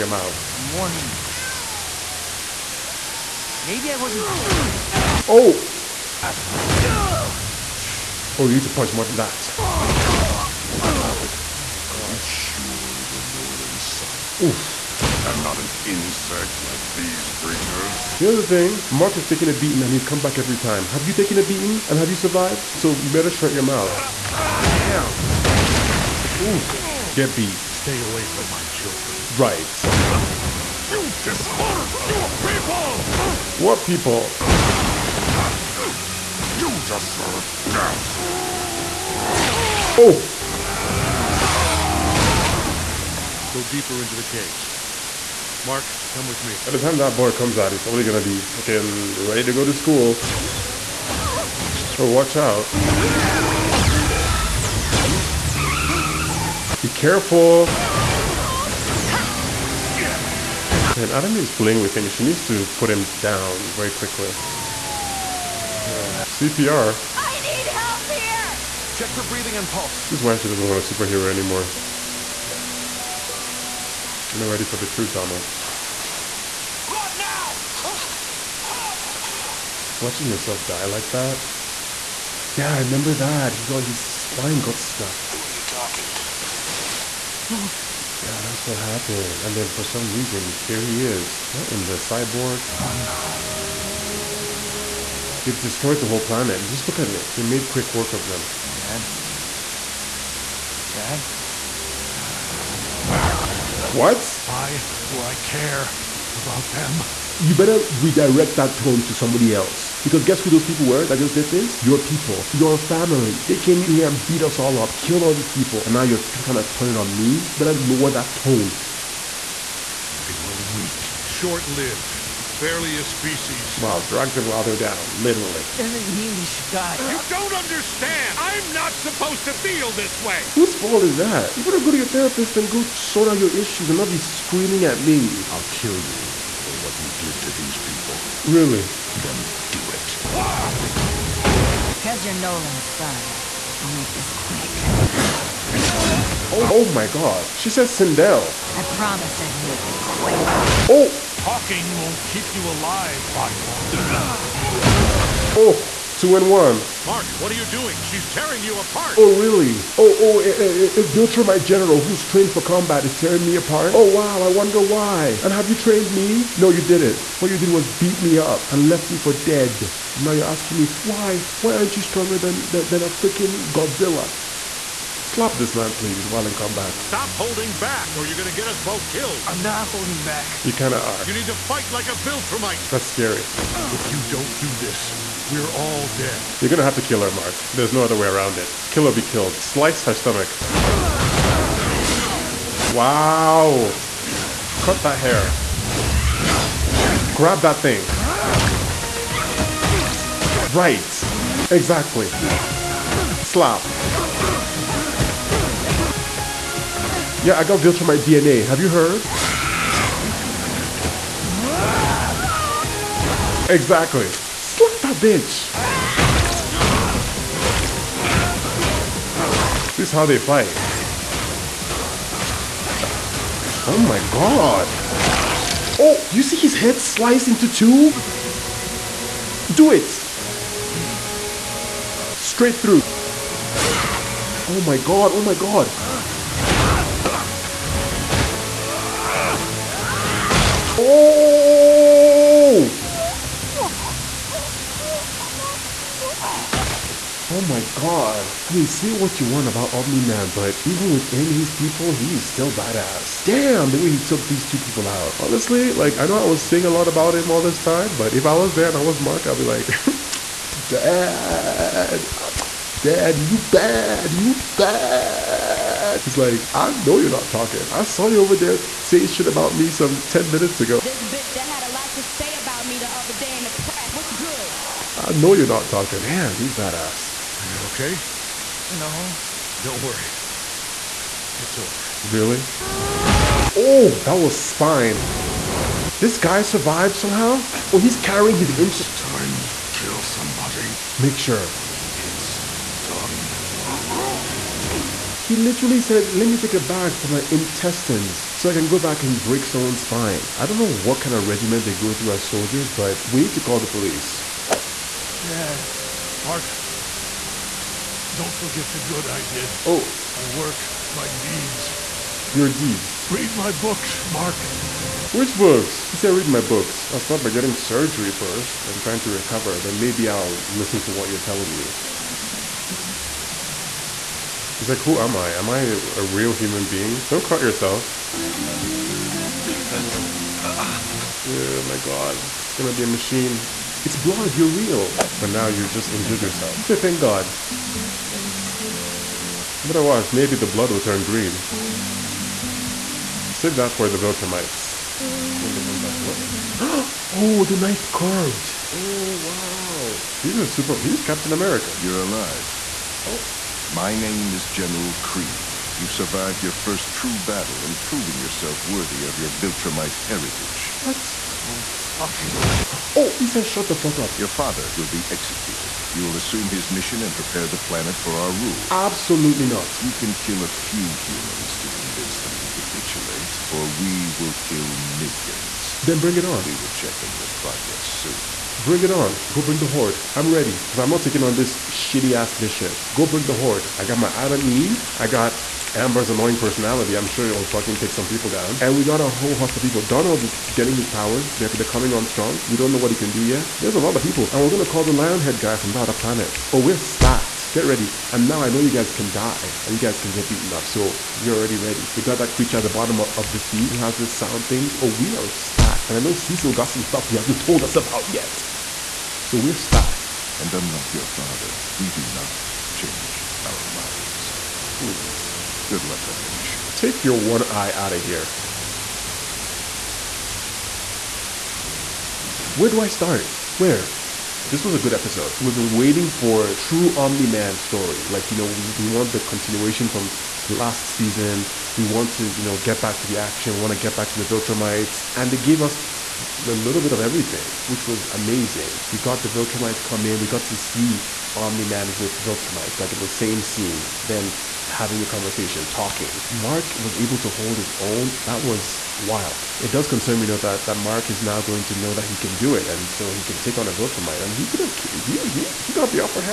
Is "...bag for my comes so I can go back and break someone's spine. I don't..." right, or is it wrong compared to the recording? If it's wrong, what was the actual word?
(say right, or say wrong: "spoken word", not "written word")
wrong: "intestines", not "comes".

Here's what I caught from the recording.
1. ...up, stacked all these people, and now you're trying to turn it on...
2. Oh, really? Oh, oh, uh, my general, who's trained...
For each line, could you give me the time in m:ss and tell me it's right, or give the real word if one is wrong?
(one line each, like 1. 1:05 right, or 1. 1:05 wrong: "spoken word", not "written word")
1. 1:54 wrong: "killed", not "stacked"
2. 2:39 right.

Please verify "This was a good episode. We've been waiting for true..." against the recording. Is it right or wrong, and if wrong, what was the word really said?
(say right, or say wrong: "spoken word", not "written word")
right.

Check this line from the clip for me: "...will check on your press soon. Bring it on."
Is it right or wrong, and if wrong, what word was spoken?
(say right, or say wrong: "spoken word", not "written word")
wrong: "progress", not "press".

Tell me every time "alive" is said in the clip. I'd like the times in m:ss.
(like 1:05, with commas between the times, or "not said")
2:32, 5:52.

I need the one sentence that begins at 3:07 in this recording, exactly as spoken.
There's no other way around it.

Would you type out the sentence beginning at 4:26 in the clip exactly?
He's like, I know you're not talking.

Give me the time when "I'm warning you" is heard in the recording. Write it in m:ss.
0:00.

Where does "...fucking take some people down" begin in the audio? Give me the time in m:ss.
6:27.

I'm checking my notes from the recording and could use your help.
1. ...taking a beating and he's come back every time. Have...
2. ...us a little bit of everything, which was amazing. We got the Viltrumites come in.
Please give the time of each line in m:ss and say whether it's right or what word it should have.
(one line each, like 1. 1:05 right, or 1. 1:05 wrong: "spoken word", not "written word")
1. 0:19 right
2. 7:15 right.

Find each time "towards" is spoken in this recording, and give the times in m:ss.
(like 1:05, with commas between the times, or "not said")
not said.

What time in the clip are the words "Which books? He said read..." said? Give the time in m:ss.
5:15.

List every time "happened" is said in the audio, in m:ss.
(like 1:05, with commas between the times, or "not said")
1:28.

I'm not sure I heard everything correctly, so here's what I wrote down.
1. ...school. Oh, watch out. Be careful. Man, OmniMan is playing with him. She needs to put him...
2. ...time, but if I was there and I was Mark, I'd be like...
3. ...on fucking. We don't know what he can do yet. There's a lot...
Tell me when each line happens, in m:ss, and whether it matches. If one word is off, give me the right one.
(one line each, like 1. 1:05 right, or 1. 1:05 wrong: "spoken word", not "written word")
1. 0:49 wrong: "Adam", not "OmniMan"
2. 4:17 right
3. 6:32 wrong: "strong", not "fucking".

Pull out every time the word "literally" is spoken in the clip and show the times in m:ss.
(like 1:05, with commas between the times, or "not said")
2:05, 4:55.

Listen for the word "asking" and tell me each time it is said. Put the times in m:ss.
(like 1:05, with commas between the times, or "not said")
2:50.